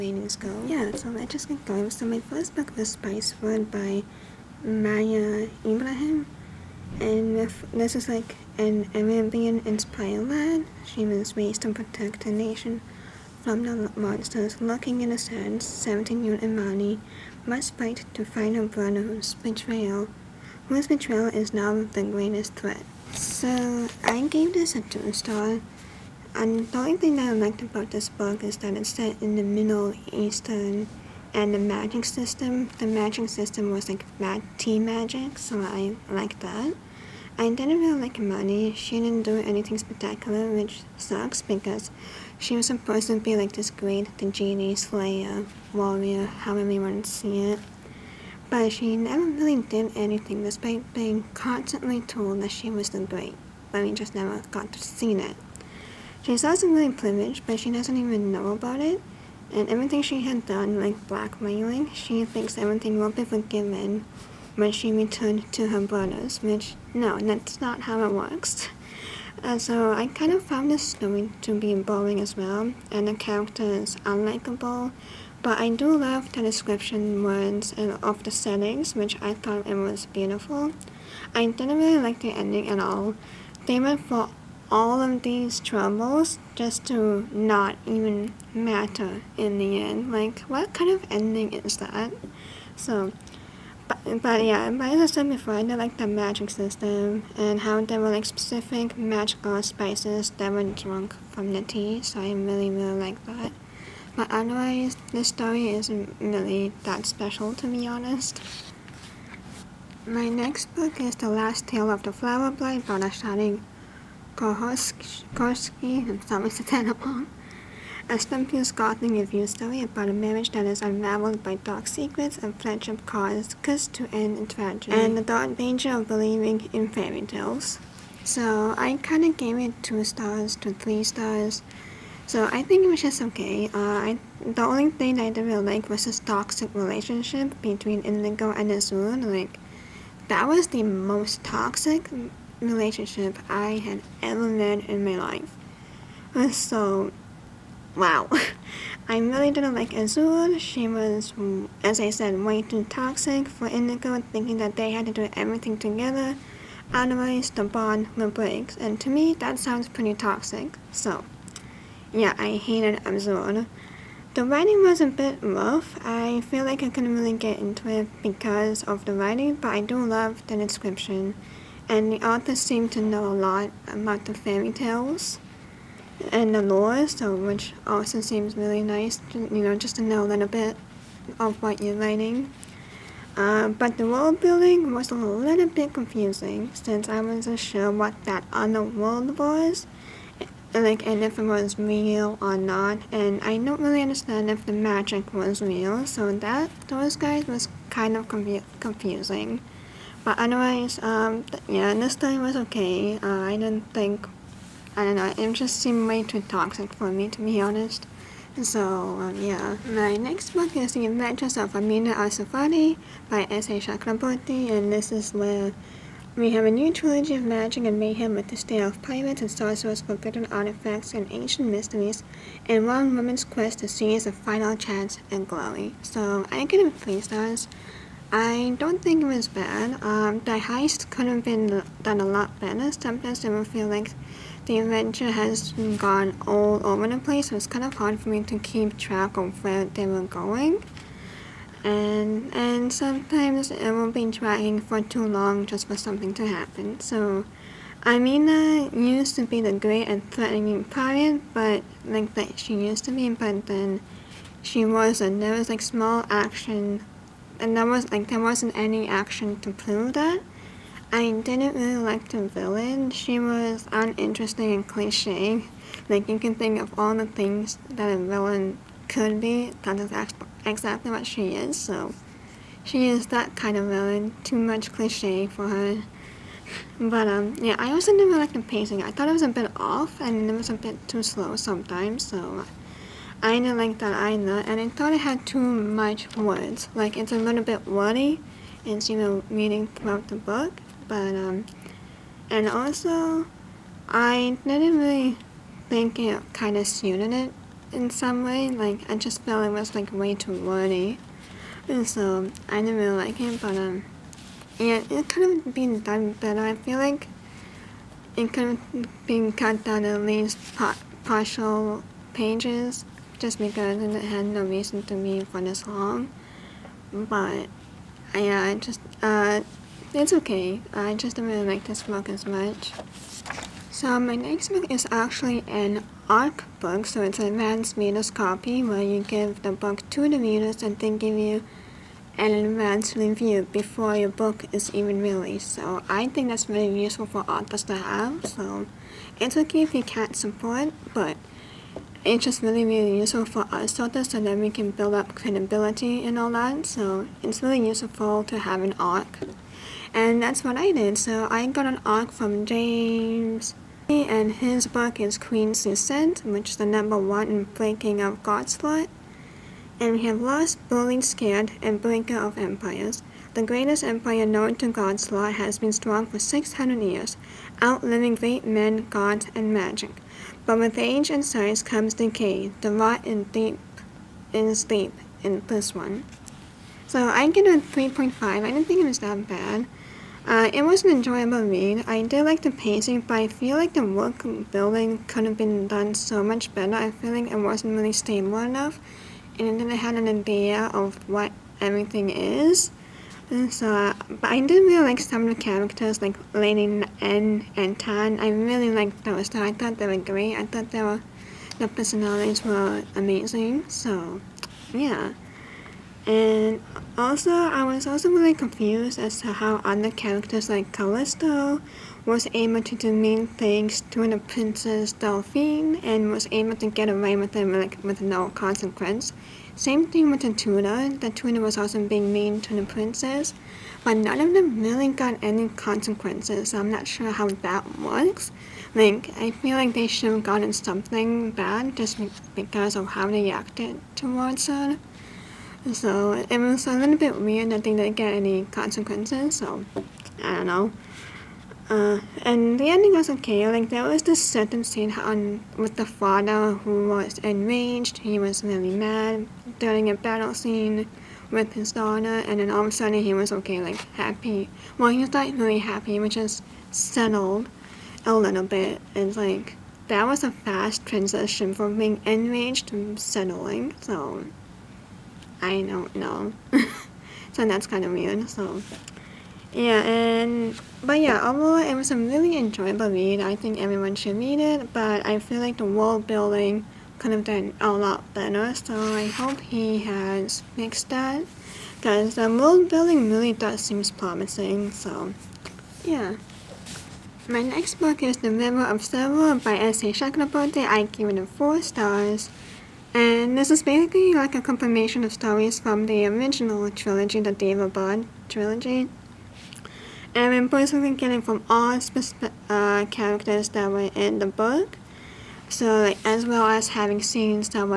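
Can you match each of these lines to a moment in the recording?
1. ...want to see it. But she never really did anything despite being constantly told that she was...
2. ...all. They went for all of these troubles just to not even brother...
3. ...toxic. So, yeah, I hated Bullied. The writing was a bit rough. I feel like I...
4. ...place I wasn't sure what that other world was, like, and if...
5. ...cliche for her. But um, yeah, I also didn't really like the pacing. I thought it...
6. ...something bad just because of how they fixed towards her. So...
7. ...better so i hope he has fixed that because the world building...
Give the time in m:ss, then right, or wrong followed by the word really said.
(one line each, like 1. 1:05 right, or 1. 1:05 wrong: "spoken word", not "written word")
1. 0:46 right
2. 1:22 wrong: "matter", not "brother"
3. 2:40 wrong: "Azul", not "Bullied"
4. 3:06 wrong: "since", not "place"
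5. 4:34 right
6. 7:10 wrong: "acted", not "fixed"
7. 7:58 right.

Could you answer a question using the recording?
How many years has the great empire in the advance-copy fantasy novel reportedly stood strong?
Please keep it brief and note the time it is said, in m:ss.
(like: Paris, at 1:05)
600, at 6:06.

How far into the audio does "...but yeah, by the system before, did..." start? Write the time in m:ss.
1:34.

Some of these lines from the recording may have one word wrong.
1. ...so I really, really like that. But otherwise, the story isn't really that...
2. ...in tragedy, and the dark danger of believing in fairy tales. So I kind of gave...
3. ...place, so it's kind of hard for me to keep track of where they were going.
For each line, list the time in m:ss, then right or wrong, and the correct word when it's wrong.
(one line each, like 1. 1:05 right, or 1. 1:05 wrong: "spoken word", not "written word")
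1. 1:42 right
2. 2:04 right
3. 3:57 right.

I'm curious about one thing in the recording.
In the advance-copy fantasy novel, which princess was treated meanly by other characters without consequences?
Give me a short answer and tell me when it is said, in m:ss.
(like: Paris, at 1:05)
Delphine, at 6:54.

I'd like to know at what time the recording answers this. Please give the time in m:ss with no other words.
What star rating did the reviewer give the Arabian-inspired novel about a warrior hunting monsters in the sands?
0:24.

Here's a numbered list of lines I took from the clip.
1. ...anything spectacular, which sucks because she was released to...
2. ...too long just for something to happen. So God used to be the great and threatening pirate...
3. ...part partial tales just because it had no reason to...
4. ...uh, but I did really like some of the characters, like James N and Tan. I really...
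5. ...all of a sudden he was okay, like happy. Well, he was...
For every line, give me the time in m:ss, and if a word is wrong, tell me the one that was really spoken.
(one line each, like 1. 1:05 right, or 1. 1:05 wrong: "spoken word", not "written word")
1. 0:39 wrong: "supposed", not "released"
2. 4:05 wrong: "Amina", not "God"
3. 5:10 wrong: "pages", not "tales"
4. 6:33 wrong: "Lady", not "James"
5. 7:32 right.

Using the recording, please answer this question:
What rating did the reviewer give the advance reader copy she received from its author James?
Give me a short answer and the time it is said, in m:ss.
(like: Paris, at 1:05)
3.5, at 6:17.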